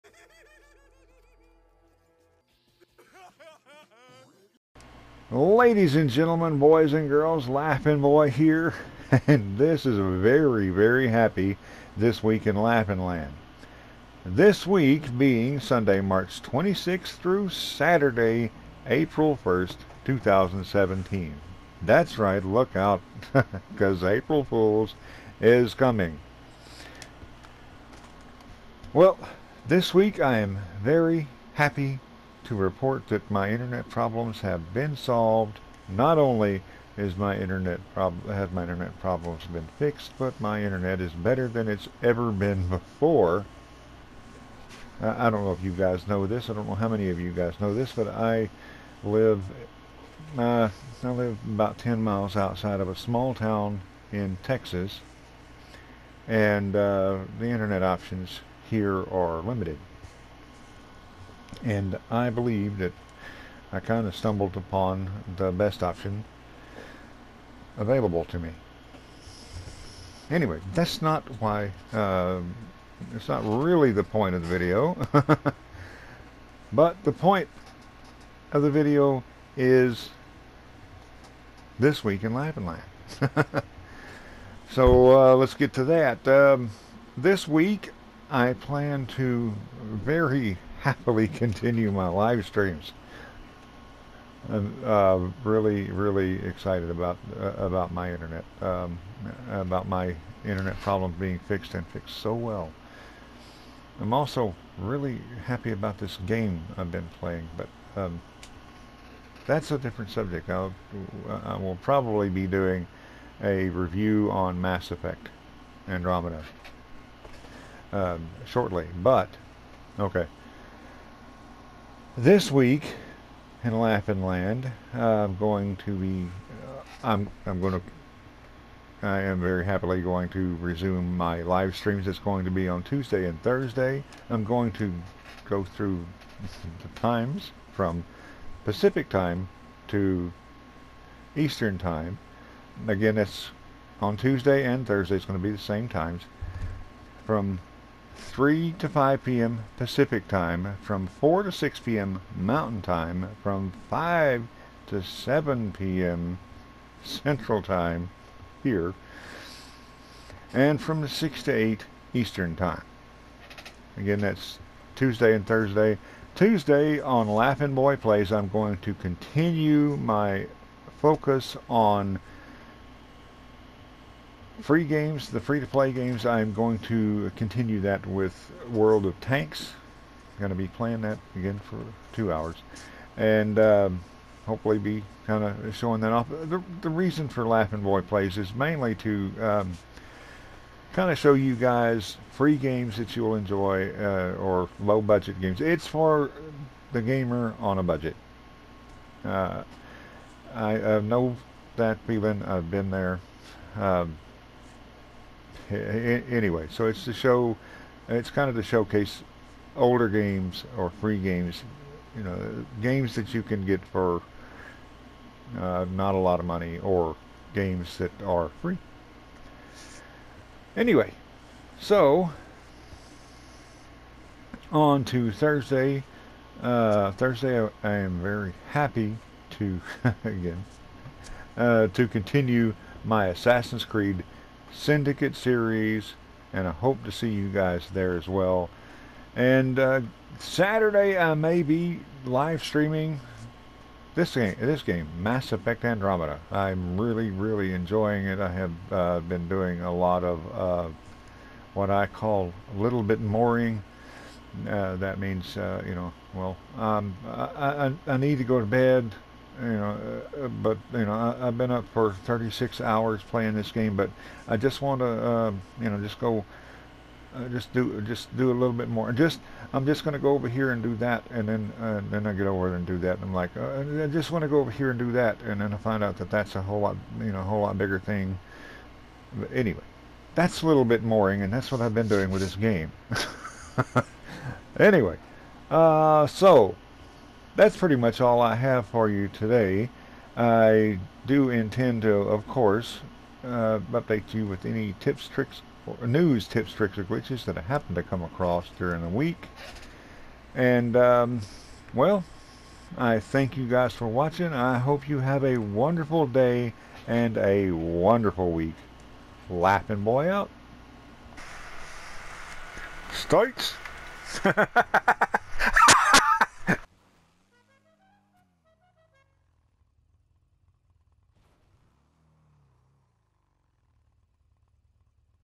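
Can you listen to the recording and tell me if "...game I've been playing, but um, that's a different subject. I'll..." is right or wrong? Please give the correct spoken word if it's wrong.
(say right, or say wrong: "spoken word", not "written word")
right.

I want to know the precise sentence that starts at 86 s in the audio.
Um, this week I plan to very happily continue my live streams.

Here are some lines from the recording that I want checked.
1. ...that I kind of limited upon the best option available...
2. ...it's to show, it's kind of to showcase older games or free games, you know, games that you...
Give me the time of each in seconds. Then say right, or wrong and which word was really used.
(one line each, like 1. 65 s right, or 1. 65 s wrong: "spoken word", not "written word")
1. 62 s wrong: "stumbled", not "limited"
2. 206 s right.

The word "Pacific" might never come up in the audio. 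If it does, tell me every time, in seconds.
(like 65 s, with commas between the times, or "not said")
138 s, 149 s.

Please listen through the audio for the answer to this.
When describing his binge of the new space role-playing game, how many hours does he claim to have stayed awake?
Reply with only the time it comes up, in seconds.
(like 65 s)
262 s.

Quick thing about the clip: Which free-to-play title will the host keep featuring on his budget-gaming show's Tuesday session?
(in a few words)
World of Tanks.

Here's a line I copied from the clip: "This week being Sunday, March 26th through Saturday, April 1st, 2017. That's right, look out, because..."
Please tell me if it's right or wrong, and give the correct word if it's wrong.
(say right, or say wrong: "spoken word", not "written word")
right.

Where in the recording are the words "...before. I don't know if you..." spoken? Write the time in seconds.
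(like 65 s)
42 s.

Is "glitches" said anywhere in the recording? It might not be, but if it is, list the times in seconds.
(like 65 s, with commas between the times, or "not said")
297 s.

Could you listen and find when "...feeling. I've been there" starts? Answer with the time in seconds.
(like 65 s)
202 s.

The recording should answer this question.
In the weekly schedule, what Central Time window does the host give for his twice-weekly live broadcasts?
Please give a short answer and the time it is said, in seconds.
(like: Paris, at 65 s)
5 to 7 p.m., at 153 s.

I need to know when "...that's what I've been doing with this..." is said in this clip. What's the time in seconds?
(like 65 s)
281 s.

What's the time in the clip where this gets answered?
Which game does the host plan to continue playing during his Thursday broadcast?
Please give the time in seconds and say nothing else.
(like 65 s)
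233 s.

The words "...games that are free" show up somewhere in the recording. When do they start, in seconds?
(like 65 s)
217 s.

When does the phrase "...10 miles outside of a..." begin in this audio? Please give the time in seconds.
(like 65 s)
51 s.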